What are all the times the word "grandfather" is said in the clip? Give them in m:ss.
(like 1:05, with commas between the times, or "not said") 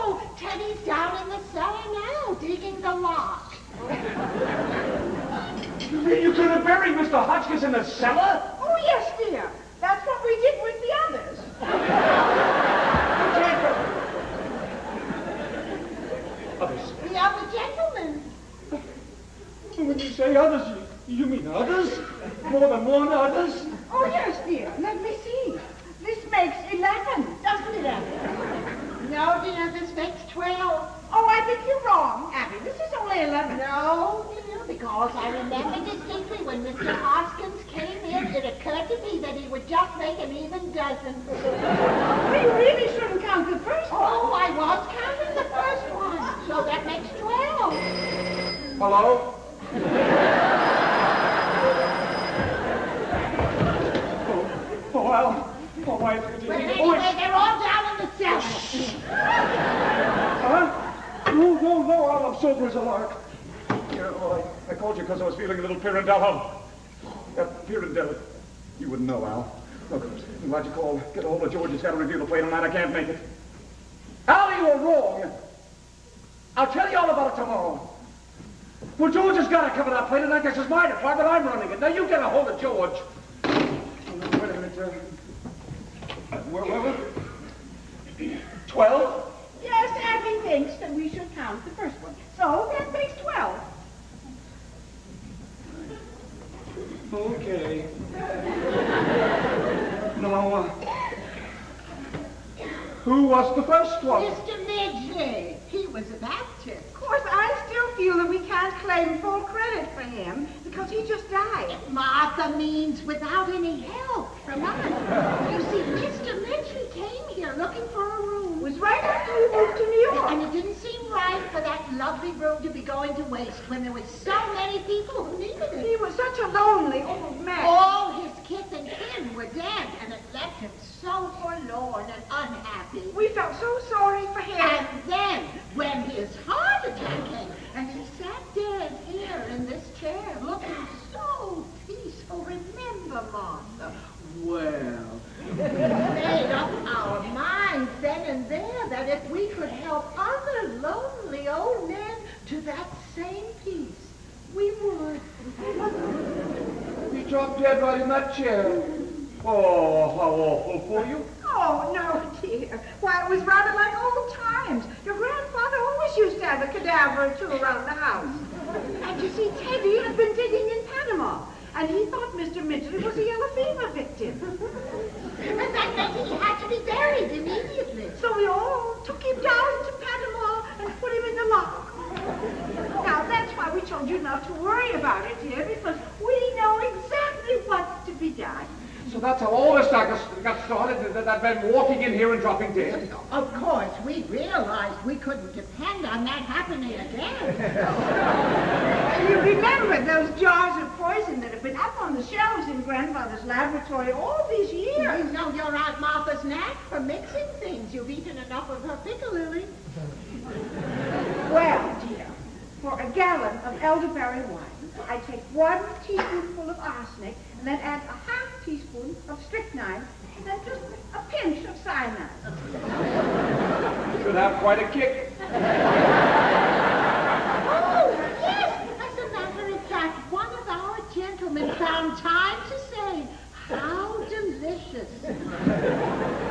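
2:45, 3:22.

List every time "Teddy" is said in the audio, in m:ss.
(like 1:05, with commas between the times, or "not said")
0:00, 2:49.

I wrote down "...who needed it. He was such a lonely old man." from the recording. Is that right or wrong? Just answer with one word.
right.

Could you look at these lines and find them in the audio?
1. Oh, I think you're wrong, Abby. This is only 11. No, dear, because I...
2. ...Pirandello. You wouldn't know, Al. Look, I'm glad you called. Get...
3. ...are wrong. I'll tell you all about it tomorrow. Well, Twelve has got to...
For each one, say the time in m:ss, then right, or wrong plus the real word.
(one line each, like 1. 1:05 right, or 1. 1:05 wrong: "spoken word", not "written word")
1. 0:31 right
2. 1:07 right
3. 1:14 wrong: "George", not "Twelve".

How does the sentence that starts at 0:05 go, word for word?
you mean you could have buried Mr.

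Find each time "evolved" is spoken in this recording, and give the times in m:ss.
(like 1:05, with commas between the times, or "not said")
not said.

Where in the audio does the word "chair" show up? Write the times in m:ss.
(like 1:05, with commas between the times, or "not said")
2:19, 2:38.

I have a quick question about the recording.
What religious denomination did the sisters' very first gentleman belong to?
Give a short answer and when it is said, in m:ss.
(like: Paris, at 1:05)
Baptist, at 1:46.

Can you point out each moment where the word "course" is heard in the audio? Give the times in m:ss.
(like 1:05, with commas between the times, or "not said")
1:47, 3:13.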